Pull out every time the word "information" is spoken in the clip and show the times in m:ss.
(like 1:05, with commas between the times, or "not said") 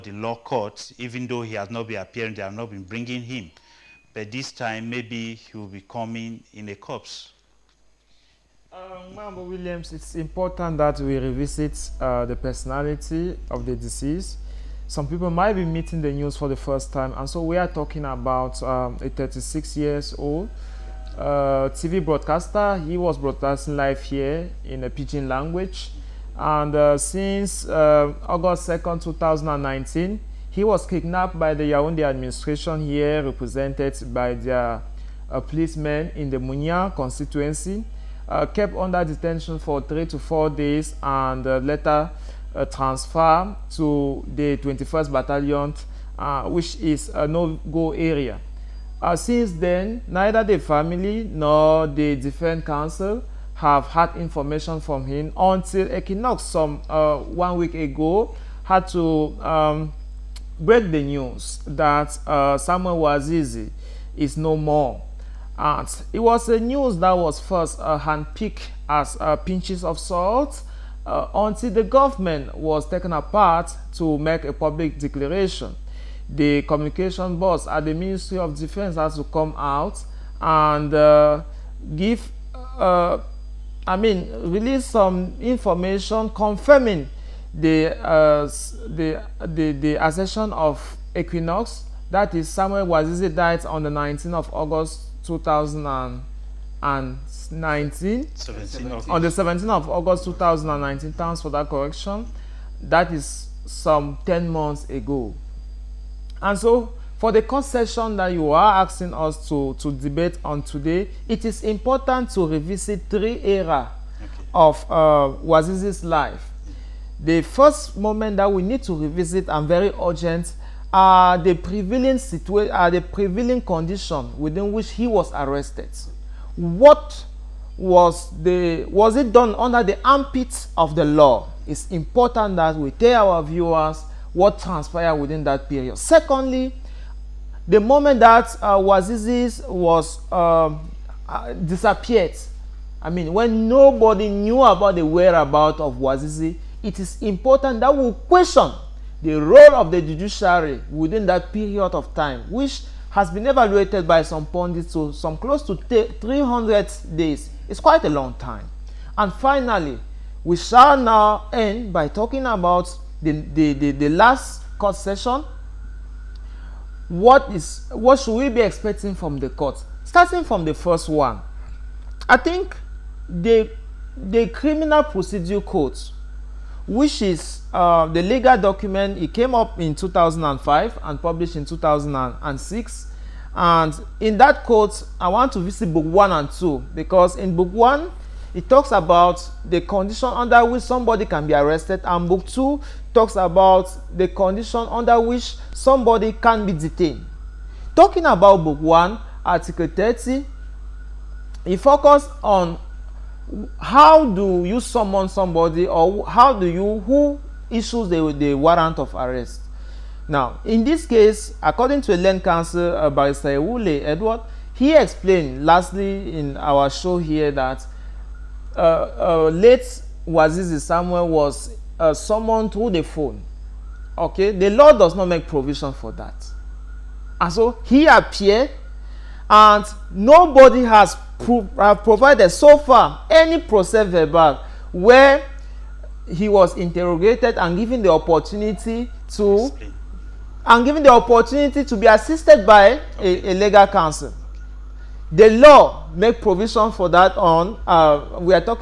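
0:54, 1:25.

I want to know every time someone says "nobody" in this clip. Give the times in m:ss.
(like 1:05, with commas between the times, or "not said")
2:23, 3:50.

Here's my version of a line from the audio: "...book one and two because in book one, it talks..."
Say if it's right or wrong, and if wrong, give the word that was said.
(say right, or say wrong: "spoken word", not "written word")
right.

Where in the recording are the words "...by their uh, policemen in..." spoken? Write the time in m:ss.
0:34.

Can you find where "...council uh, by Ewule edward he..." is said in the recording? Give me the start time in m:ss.
3:32.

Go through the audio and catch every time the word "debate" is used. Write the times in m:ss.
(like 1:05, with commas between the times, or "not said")
1:49.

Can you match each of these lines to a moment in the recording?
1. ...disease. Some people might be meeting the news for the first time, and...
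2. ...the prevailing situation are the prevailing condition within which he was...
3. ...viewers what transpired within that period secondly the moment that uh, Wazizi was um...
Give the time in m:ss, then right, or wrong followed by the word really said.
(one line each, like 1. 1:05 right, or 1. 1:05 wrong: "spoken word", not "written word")
1. 0:13 right
2. 2:01 right
3. 2:13 right.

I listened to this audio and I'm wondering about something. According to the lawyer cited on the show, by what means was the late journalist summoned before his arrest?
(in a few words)
the phone.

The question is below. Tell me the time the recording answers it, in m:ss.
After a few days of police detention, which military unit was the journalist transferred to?
0:44.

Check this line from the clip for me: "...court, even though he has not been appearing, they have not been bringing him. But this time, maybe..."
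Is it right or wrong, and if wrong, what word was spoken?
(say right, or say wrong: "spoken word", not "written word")
right.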